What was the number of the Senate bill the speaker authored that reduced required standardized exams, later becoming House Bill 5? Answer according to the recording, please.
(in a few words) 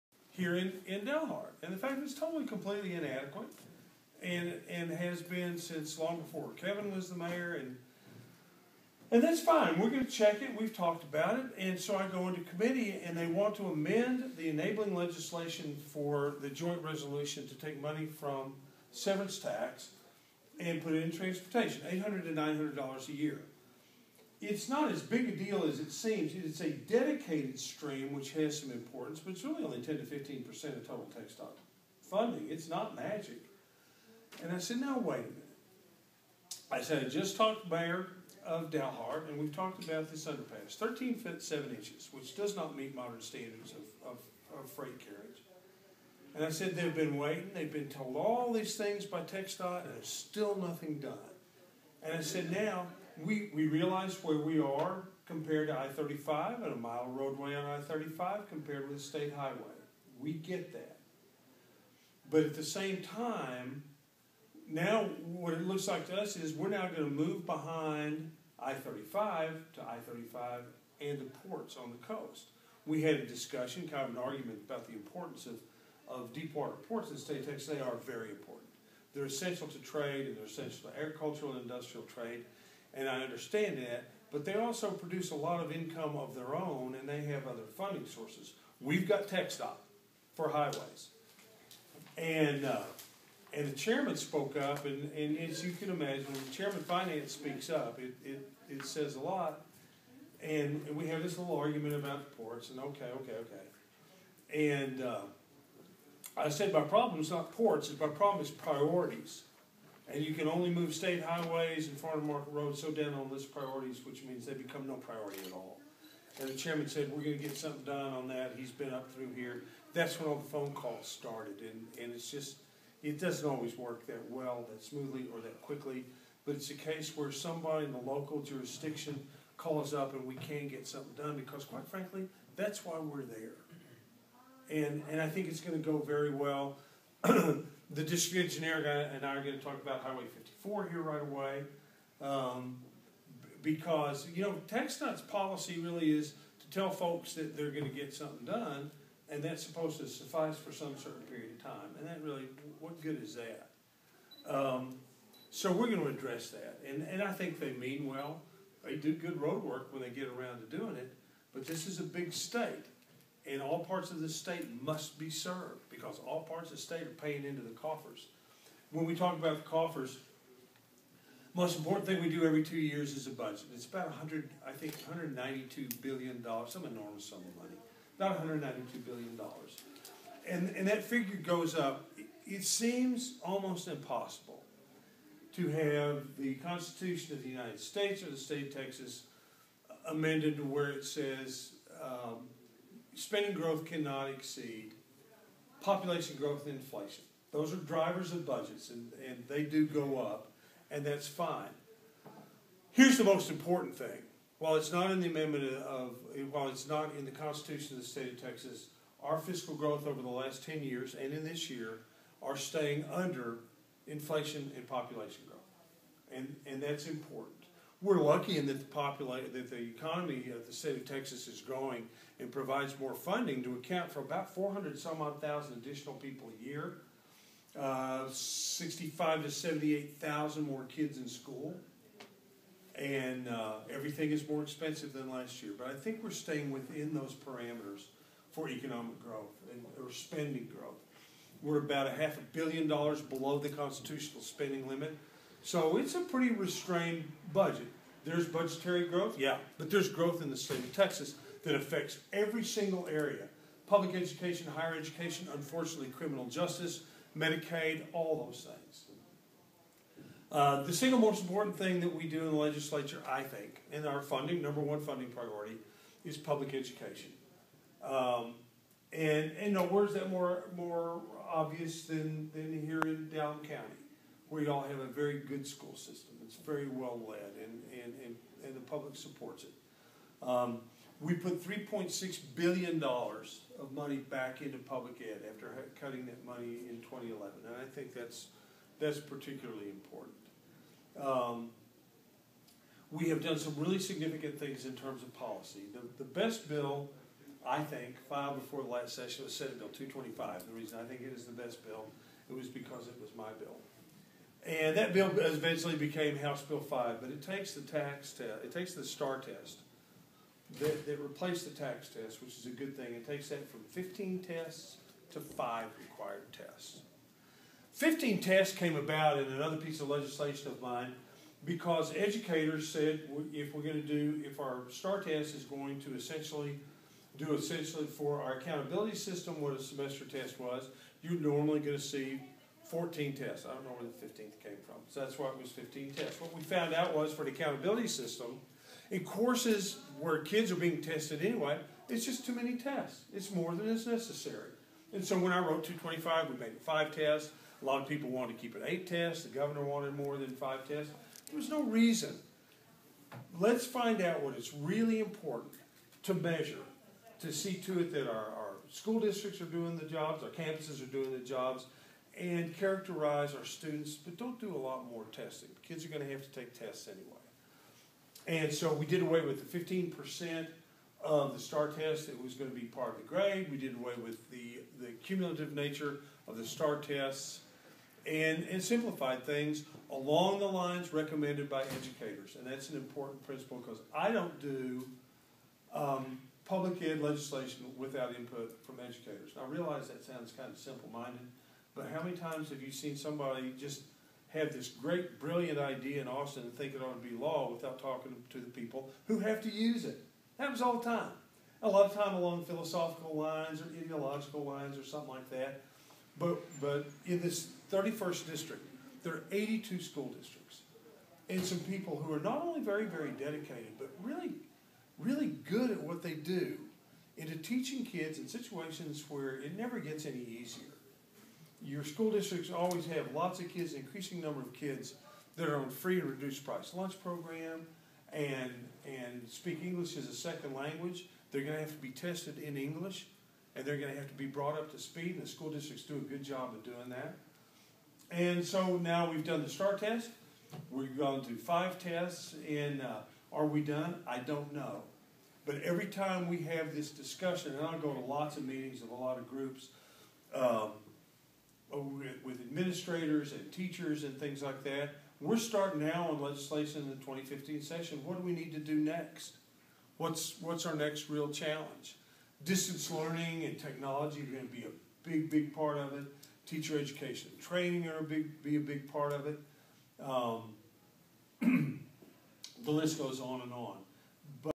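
Senate Bill 225.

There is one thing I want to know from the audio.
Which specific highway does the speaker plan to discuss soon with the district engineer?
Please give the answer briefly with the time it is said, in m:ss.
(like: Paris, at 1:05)
Highway 54, at 2:20.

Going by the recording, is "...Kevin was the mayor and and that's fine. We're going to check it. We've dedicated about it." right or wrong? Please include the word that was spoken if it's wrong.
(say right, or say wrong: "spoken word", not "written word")
wrong: "talked", not "dedicated".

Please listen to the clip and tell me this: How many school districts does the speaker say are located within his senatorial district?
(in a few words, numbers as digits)
82.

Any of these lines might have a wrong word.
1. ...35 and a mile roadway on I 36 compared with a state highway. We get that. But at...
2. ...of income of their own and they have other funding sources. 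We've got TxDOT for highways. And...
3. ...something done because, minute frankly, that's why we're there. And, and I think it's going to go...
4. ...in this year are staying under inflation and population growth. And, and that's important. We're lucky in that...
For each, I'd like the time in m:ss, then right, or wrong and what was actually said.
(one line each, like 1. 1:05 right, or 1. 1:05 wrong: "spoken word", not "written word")
1. 0:55 wrong: "35", not "36"
2. 1:25 right
3. 2:10 wrong: "quite", not "minute"
4. 3:31 right.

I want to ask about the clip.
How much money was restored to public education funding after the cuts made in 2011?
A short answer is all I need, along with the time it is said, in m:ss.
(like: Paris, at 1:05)
$3.6 billion, at 4:41.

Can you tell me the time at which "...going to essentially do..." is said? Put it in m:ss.
5:25.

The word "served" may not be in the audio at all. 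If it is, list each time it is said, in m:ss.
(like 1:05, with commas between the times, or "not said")
2:45.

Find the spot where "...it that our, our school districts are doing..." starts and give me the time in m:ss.
5:58.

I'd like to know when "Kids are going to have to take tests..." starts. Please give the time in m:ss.
6:05.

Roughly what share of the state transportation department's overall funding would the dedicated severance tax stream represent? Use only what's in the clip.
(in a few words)
10 to 15%.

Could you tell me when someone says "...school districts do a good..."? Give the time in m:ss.
7:15.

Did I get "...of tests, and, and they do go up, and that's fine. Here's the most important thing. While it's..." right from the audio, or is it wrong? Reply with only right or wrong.
wrong.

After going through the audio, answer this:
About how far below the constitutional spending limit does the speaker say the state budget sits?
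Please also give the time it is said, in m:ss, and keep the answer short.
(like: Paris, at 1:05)
half a billion dollars, at 4:02.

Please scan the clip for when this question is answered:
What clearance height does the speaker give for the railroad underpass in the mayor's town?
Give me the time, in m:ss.
0:40.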